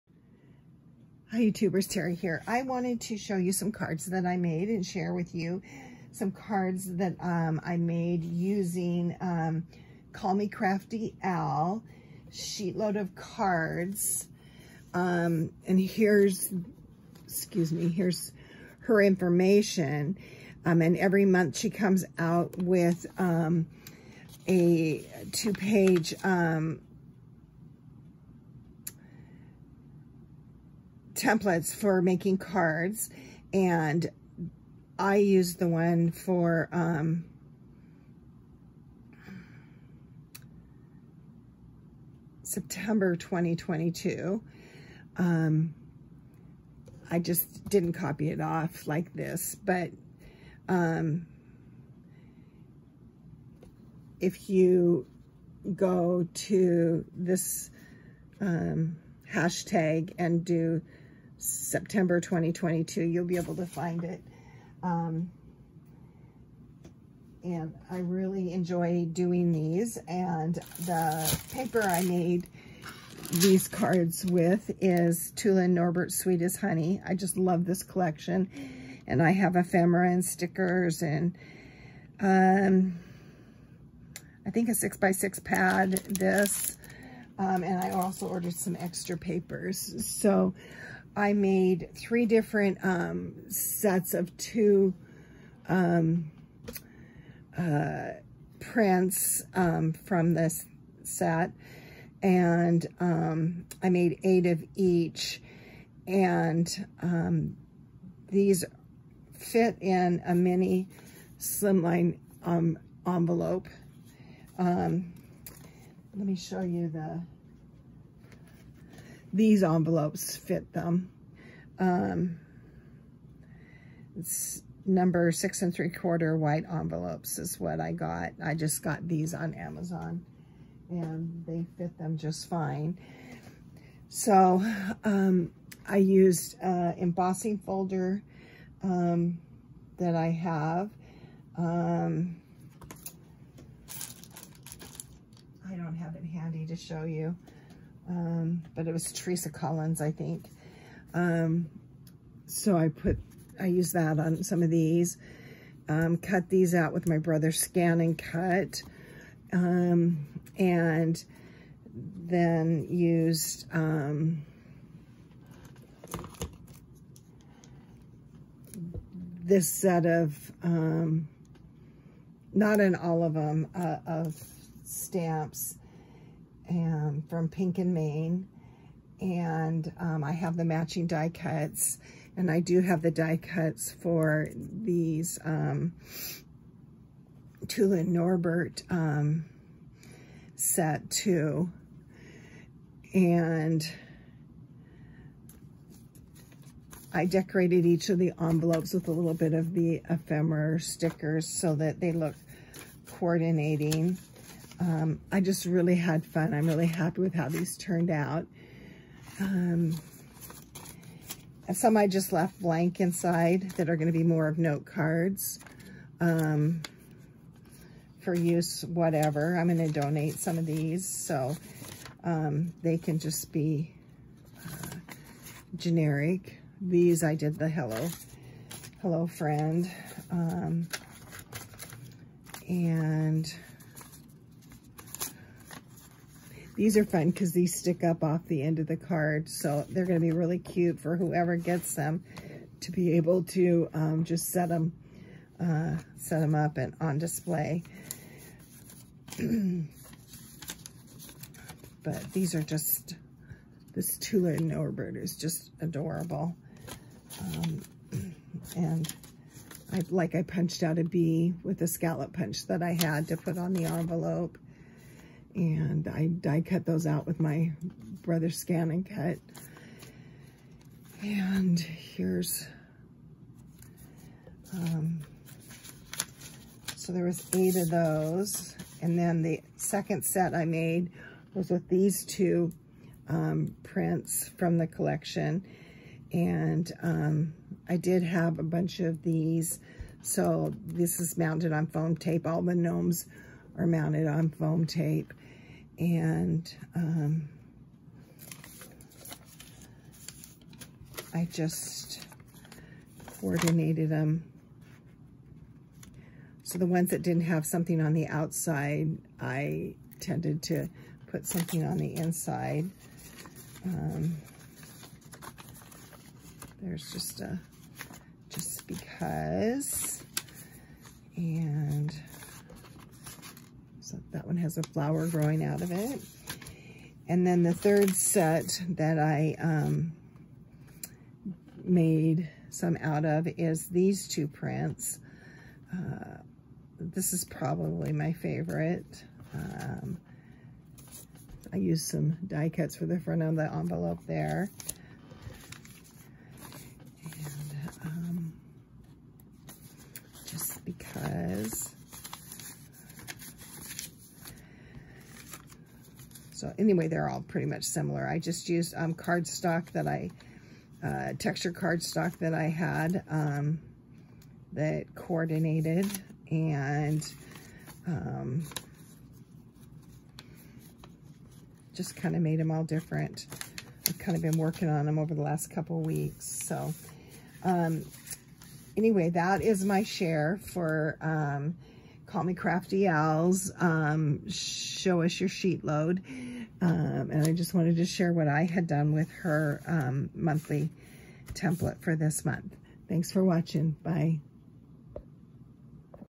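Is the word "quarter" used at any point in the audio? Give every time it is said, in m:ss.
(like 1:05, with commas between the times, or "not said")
2:05.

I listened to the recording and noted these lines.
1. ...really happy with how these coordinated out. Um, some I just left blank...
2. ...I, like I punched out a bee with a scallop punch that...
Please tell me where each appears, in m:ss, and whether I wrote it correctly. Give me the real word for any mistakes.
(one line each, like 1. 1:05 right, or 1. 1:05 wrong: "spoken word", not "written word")
1. 3:26 wrong: "turned", not "coordinated"
2. 4:19 right.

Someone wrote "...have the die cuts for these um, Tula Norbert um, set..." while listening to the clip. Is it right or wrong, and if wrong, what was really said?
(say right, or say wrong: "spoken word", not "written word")
right.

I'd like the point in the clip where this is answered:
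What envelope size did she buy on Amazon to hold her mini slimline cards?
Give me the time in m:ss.
2:05.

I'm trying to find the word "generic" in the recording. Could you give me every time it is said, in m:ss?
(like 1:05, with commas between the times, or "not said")
3:45.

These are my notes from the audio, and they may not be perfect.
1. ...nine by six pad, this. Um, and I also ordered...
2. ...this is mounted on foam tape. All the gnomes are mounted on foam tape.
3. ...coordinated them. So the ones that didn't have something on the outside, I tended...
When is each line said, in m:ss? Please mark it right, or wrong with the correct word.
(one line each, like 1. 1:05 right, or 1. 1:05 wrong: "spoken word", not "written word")
1. 1:24 wrong: "six", not "nine"
2. 4:50 right
3. 5:03 right.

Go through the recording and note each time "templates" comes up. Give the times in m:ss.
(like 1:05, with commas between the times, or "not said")
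0:31, 6:31.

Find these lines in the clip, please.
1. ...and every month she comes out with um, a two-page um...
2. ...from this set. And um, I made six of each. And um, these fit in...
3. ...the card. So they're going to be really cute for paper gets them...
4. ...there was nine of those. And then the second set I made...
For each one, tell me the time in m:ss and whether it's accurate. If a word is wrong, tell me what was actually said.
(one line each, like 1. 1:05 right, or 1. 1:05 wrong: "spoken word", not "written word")
1. 0:20 right
2. 1:39 wrong: "eight", not "six"
3. 3:58 wrong: "whoever", not "paper"
4. 4:37 wrong: "eight", not "nine".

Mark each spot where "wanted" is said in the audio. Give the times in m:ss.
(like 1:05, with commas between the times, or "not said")
0:02, 6:27.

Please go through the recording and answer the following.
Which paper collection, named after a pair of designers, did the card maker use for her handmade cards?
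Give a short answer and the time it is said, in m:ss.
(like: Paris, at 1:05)
Sweet as Honey, at 1:16.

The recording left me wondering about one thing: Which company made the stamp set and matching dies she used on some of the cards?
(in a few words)
Pink and Main.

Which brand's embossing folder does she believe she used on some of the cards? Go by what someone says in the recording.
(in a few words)
Teresa Collins.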